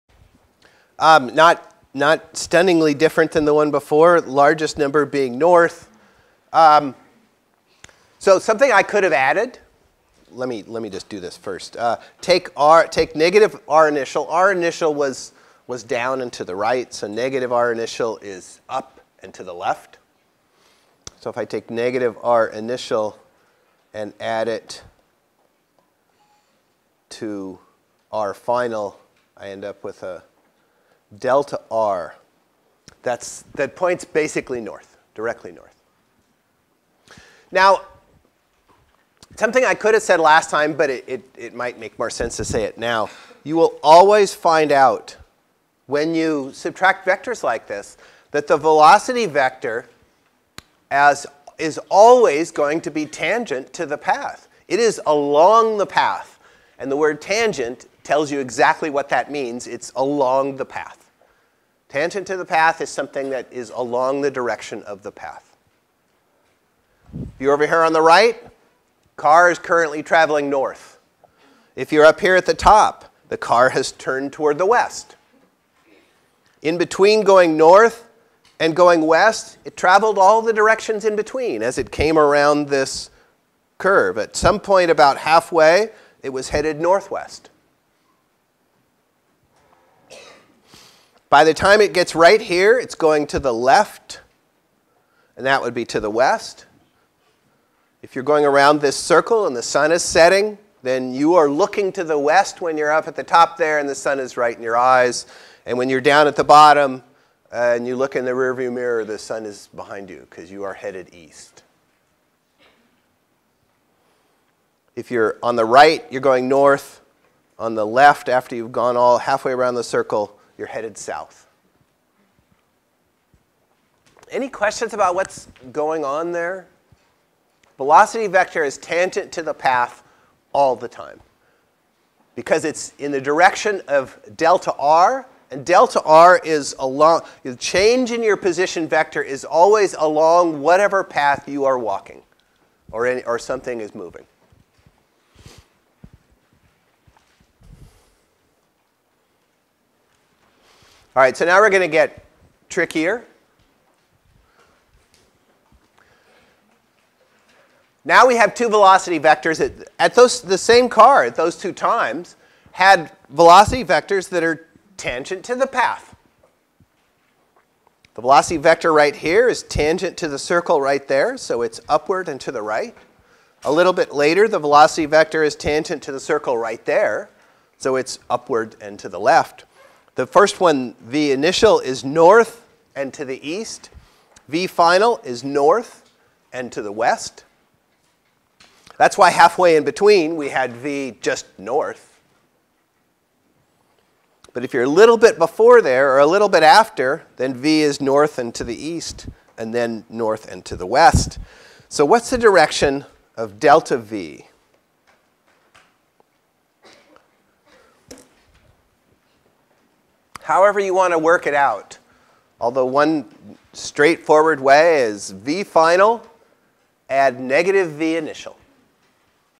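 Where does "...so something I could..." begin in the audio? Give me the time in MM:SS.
00:08.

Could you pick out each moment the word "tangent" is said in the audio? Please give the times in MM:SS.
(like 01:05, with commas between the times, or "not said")
00:53, 00:57, 01:01, 02:08, 02:44, 02:49, 02:55.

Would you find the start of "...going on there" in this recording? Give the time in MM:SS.
02:05.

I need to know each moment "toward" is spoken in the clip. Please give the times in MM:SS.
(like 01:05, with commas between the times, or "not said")
01:14.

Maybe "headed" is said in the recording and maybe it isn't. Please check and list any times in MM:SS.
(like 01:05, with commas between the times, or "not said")
01:26, 01:50, 02:00.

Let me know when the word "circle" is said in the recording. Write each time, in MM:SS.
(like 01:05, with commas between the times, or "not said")
01:38, 01:59, 02:50, 02:56.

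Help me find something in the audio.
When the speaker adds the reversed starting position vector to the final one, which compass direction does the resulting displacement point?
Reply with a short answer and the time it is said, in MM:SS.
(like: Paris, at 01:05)
Directly north, at 00:35.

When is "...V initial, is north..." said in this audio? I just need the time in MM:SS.
03:00.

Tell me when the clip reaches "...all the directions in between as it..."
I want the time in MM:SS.
01:20.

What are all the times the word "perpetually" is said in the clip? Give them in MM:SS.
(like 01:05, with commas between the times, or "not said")
not said.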